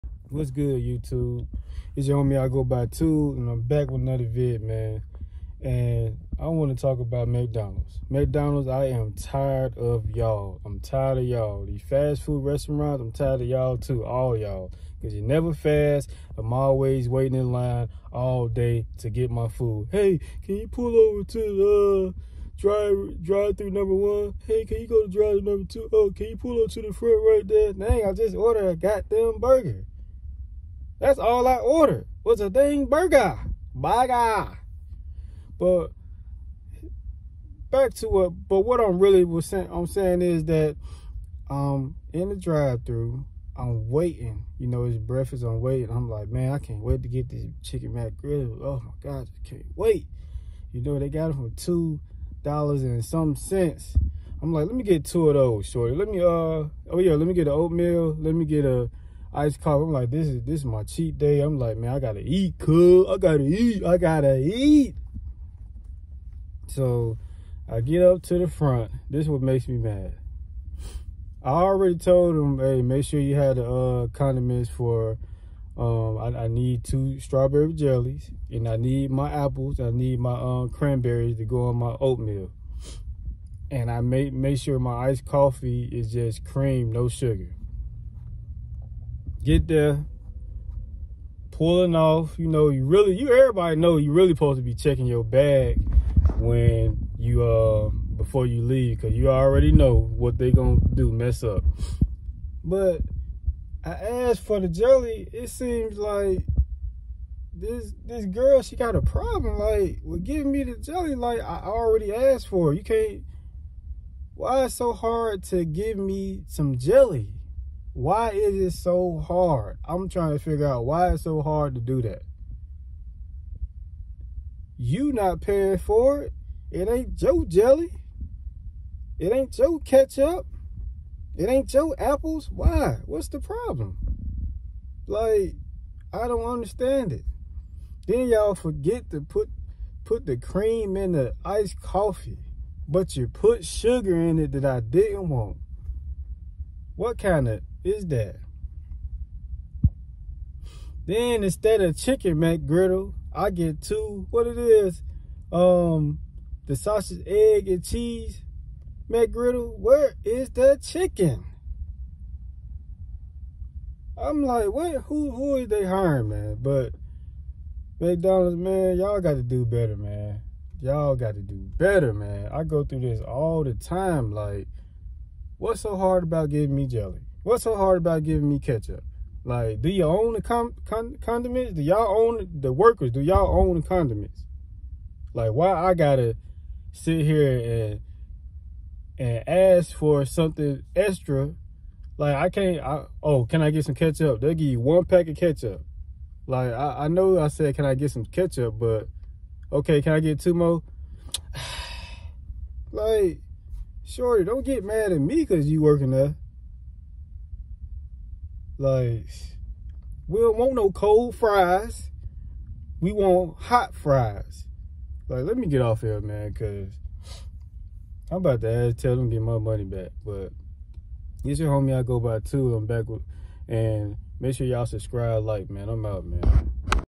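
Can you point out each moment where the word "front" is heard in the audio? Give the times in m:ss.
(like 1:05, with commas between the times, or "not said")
0:26, 1:08.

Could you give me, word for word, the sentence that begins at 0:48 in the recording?
Oh my god, I can't wait.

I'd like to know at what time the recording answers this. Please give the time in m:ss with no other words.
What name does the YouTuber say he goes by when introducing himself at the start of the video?
0:02.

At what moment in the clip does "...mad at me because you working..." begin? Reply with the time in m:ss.
3:24.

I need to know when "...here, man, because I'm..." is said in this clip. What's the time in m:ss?
3:36.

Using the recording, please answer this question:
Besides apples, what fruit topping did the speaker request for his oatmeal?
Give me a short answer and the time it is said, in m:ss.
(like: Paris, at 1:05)
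cranberries, at 1:20.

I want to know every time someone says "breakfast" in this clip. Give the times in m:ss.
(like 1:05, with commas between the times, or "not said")
0:44.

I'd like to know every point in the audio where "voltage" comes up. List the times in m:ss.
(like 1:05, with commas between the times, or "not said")
not said.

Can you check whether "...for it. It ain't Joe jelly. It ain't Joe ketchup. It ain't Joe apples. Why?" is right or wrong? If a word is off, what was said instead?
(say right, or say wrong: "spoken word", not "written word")
right.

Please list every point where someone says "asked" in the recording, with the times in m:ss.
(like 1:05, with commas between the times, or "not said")
1:43, 1:52.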